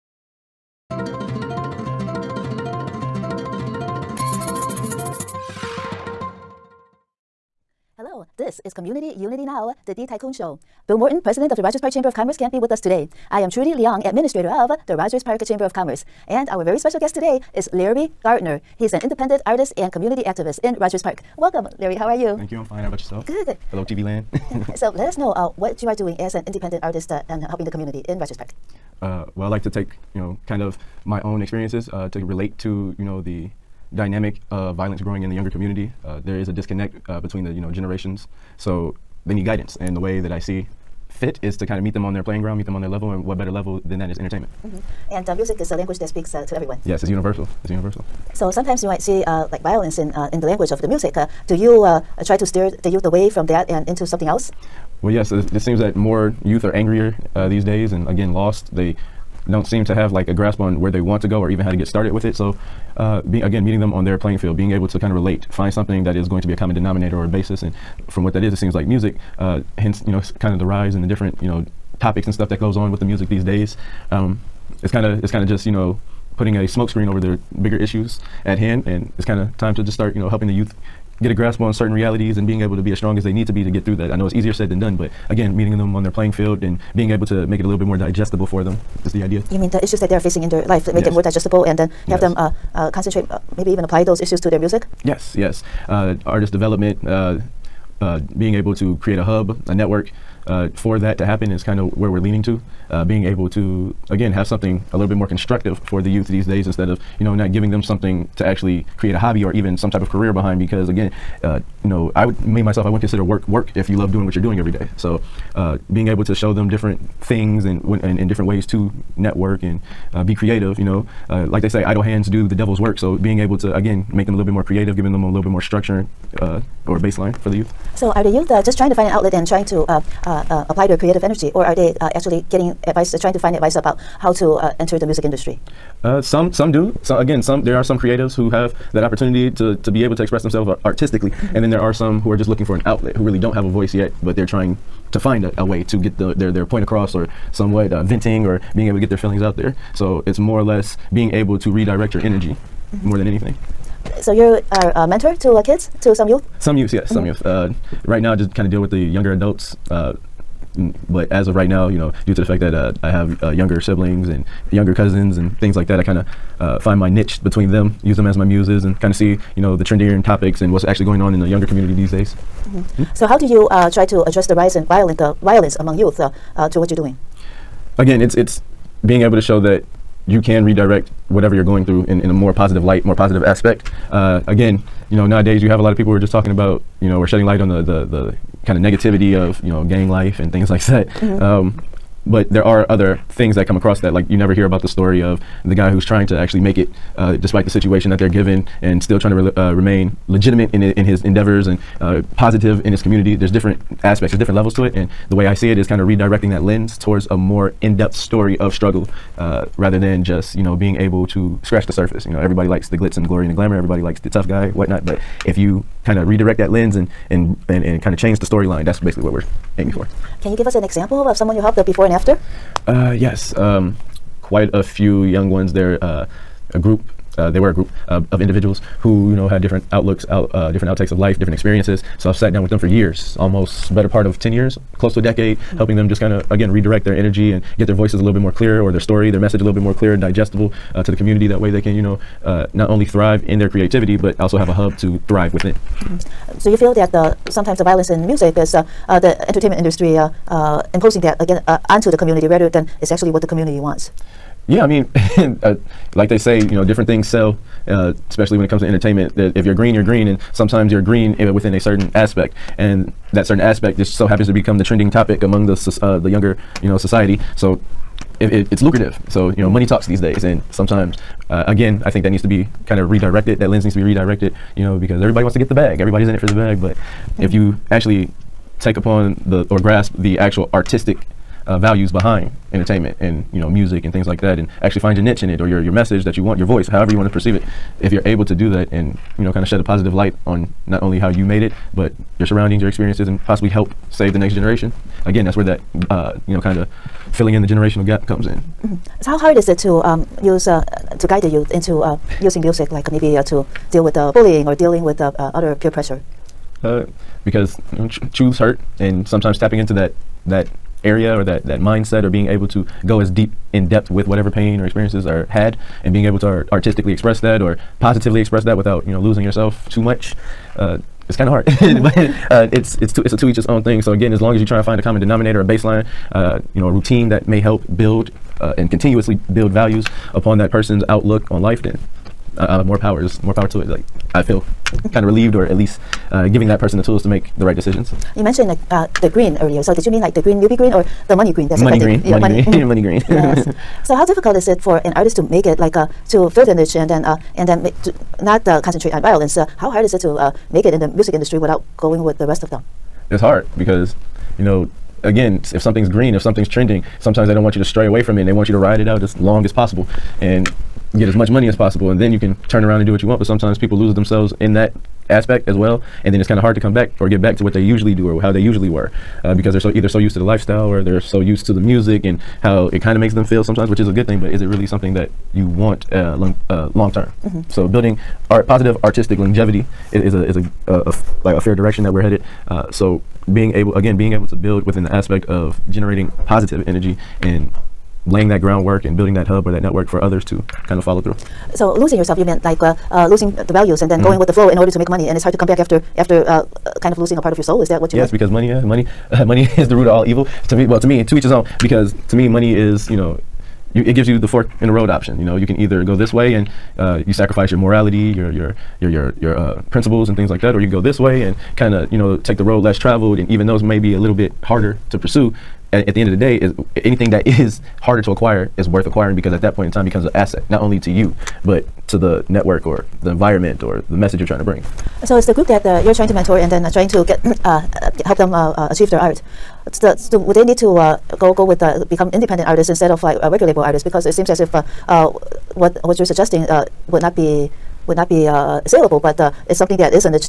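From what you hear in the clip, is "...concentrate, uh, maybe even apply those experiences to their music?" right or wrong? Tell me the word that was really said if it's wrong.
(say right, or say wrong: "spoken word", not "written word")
wrong: "issues", not "experiences".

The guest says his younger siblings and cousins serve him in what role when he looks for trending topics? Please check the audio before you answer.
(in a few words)
muses.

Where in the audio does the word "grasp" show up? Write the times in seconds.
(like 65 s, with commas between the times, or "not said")
60 s, 81 s, 279 s.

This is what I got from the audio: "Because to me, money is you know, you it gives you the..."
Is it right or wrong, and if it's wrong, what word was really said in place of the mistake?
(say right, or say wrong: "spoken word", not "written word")
right.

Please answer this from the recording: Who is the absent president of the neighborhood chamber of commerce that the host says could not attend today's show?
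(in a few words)
Bill Morton.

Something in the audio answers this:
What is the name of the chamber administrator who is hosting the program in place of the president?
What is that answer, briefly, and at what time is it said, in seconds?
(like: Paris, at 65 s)
Trudy Leong, at 13 s.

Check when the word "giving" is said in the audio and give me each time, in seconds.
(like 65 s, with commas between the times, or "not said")
107 s, 124 s, 336 s.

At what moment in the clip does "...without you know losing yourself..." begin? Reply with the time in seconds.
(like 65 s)
318 s.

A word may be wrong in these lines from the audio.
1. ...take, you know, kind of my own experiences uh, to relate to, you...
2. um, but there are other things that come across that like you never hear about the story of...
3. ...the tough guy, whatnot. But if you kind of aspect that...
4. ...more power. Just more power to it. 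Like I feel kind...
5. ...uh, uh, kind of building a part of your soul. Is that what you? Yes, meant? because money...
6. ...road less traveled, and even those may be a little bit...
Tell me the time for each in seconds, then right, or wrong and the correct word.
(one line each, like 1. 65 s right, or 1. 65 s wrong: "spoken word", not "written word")
1. 29 s right
2. 191 s right
3. 214 s wrong: "redirect", not "aspect"
4. 332 s right
5. 396 s wrong: "losing", not "building"
6. 412 s right.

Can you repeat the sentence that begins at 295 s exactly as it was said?
Again, that's where that uh, you know kind of filling in the generational gap comes in.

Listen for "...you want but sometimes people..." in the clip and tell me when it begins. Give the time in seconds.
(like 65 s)
363 s.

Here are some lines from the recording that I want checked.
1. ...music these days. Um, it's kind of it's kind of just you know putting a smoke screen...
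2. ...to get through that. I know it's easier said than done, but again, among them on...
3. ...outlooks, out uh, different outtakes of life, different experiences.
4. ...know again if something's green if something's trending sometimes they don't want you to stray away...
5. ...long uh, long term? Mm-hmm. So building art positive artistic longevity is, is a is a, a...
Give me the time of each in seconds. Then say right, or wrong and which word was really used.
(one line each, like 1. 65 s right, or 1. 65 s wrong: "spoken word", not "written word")
1. 73 s right
2. 83 s wrong: "meeting", not "among"
3. 229 s right
4. 354 s right
5. 376 s right.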